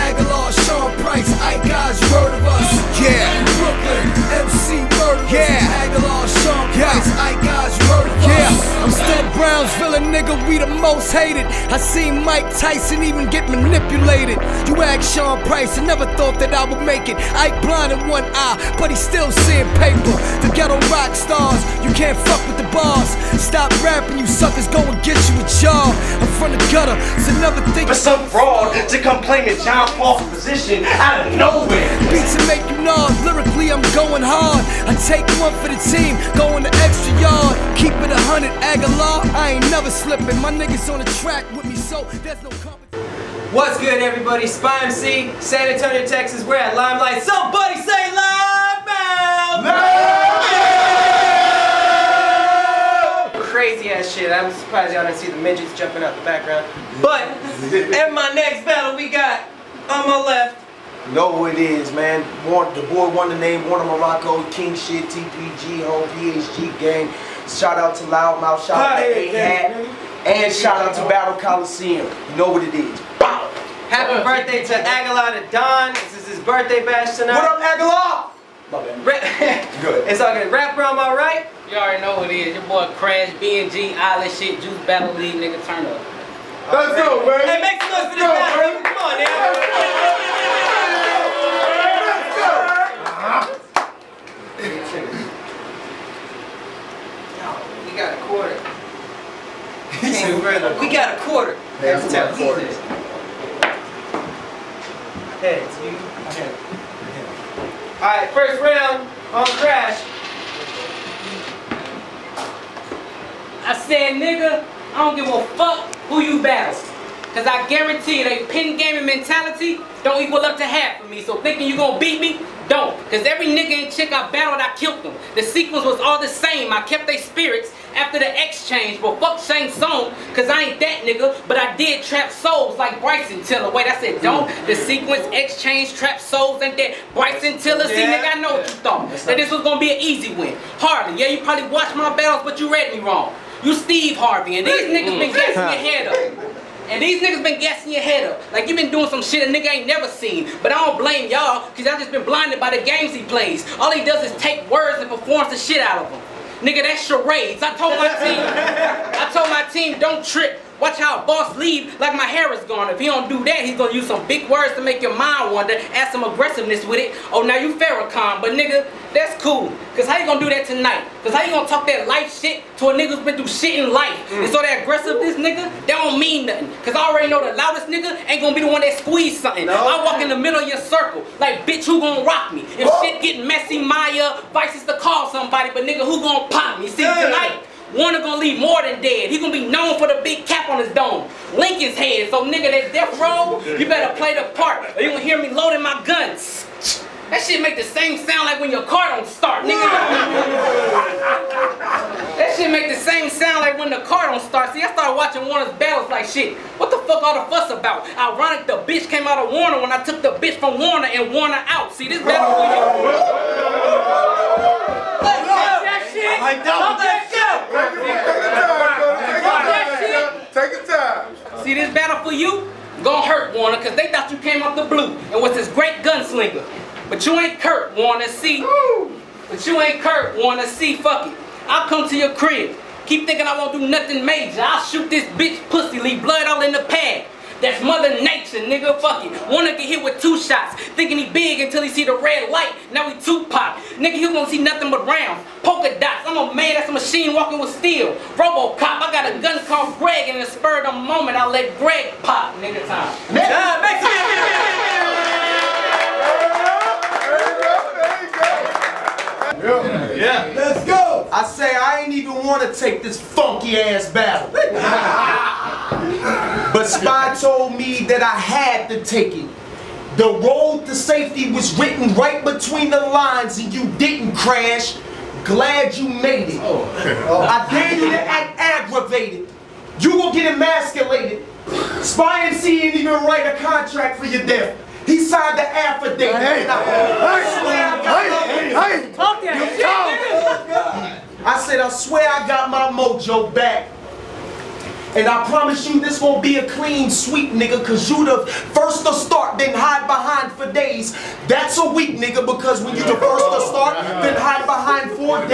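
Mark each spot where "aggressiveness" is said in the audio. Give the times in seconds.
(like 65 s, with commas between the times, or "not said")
166 s, 174 s.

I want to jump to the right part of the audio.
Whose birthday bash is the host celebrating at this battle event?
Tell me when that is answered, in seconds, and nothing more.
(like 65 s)
74 s.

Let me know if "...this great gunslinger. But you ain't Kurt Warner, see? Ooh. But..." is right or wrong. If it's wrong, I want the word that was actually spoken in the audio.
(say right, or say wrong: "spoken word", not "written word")
right.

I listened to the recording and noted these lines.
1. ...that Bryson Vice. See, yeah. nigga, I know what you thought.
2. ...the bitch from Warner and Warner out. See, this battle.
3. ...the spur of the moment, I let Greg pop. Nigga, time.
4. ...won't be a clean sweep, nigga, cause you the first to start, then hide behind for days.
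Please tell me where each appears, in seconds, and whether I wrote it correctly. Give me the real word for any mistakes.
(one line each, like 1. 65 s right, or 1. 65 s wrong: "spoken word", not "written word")
1. 136 s wrong: "Tiller", not "Vice"
2. 210 s right
3. 250 s right
4. 296 s right.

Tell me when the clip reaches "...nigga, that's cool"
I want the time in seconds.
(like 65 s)
168 s.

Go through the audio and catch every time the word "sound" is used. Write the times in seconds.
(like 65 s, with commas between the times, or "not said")
198 s, 203 s.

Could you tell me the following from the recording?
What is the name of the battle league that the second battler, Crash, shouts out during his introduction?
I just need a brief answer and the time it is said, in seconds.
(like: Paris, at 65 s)
Juice Battle League, at 84 s.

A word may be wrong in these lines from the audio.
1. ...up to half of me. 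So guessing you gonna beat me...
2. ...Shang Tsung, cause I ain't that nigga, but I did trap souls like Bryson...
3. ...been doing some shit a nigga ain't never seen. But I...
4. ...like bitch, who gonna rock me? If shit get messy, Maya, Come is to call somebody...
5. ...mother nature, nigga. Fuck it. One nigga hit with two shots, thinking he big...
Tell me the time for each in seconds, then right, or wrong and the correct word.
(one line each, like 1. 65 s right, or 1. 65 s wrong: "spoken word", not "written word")
1. 120 s wrong: "thinking", not "guessing"
2. 129 s right
3. 148 s right
4. 181 s wrong: "Vice", not "Come"
5. 237 s right.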